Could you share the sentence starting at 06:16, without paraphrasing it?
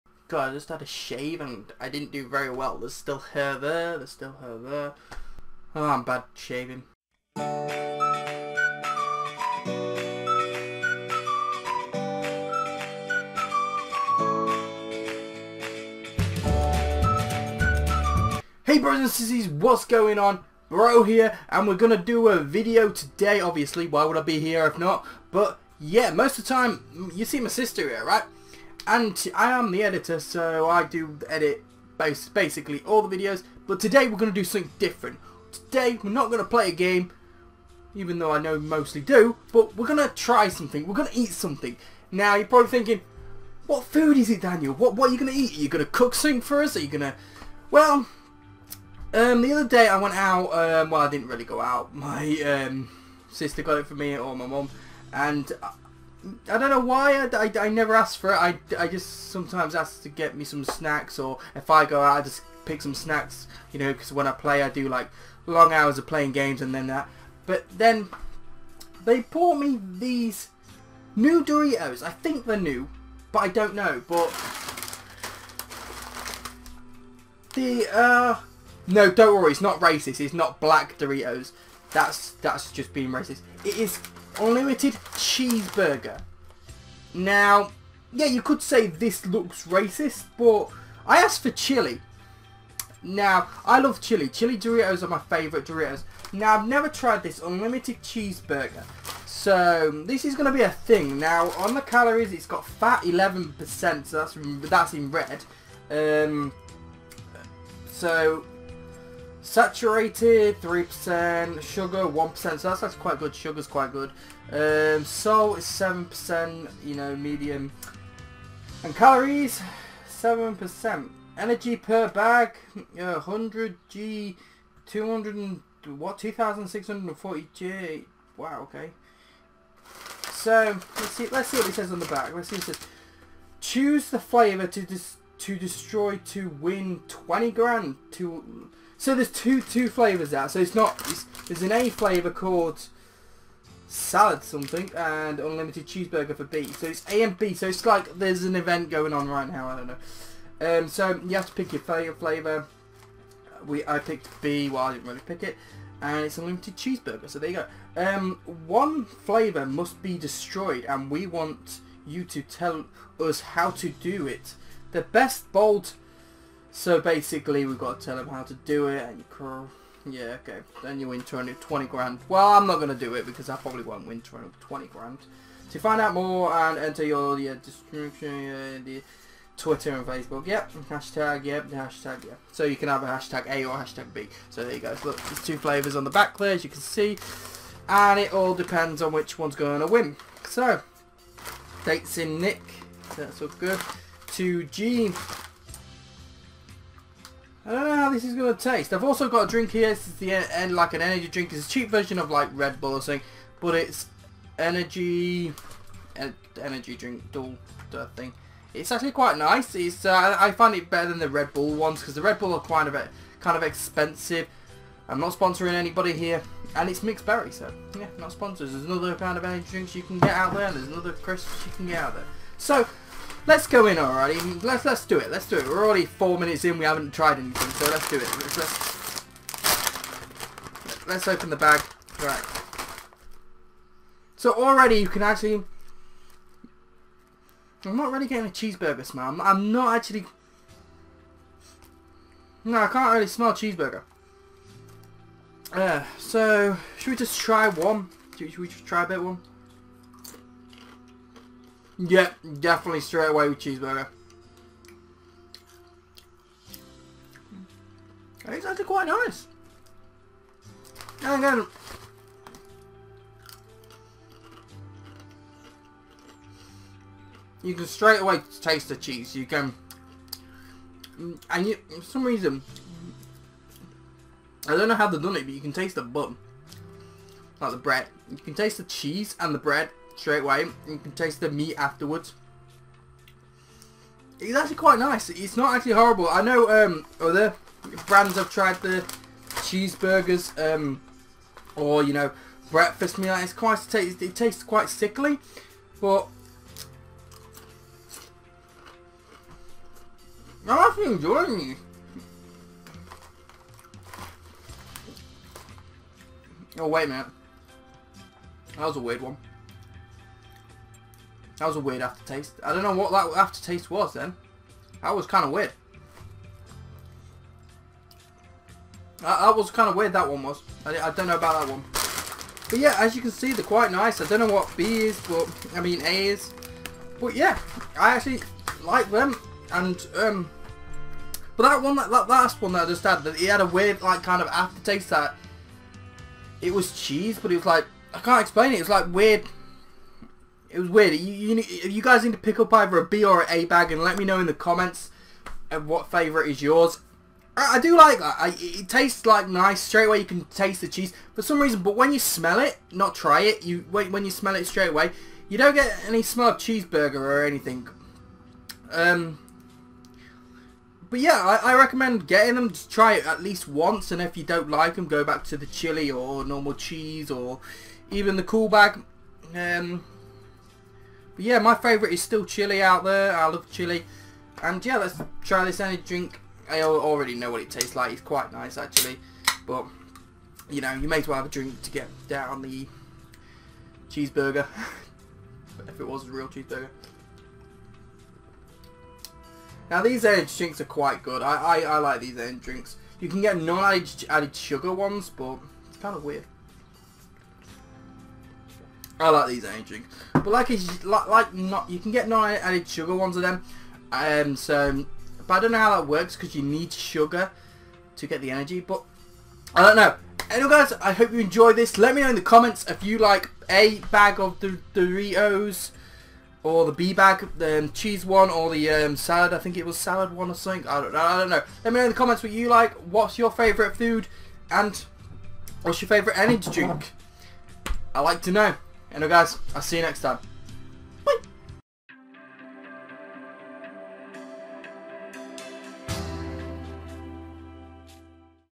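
I already know what it tastes like.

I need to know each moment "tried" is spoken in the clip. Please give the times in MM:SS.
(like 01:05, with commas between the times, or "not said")
01:36, 03:47, 04:48.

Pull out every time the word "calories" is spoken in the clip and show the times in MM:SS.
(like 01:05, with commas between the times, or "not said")
01:41, 01:58.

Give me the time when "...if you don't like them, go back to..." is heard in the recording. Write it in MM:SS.
06:04.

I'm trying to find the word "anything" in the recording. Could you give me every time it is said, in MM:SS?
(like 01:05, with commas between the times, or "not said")
03:47, 05:57.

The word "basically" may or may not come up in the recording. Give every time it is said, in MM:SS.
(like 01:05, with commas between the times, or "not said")
00:32, 02:47.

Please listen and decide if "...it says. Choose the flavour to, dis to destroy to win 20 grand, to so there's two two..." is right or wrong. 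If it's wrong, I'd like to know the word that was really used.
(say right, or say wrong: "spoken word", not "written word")
right.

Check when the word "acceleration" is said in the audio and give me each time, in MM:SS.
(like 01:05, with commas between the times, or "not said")
not said.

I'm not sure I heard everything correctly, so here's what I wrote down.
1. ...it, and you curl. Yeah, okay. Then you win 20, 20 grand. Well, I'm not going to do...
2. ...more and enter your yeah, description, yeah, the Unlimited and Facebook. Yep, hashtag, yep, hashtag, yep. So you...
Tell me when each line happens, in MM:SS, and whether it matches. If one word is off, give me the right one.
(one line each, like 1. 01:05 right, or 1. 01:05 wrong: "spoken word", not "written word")
1. 02:48 right
2. 02:56 wrong: "Twitter", not "Unlimited".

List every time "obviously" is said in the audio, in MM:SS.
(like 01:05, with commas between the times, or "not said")
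00:23.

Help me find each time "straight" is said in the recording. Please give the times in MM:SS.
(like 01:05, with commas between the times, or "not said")
04:12, 04:27, 04:40, 05:49, 05:54.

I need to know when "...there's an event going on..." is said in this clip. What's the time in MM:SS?
02:28.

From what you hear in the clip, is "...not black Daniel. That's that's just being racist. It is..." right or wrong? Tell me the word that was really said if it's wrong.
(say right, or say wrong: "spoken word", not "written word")
wrong: "Doritos", not "Daniel".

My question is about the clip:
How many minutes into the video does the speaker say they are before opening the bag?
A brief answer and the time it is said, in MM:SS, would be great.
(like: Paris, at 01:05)
4, at 03:46.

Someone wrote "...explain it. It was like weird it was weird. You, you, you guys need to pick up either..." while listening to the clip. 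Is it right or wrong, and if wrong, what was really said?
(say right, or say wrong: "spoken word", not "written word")
right.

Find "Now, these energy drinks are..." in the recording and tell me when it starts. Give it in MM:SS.
06:29.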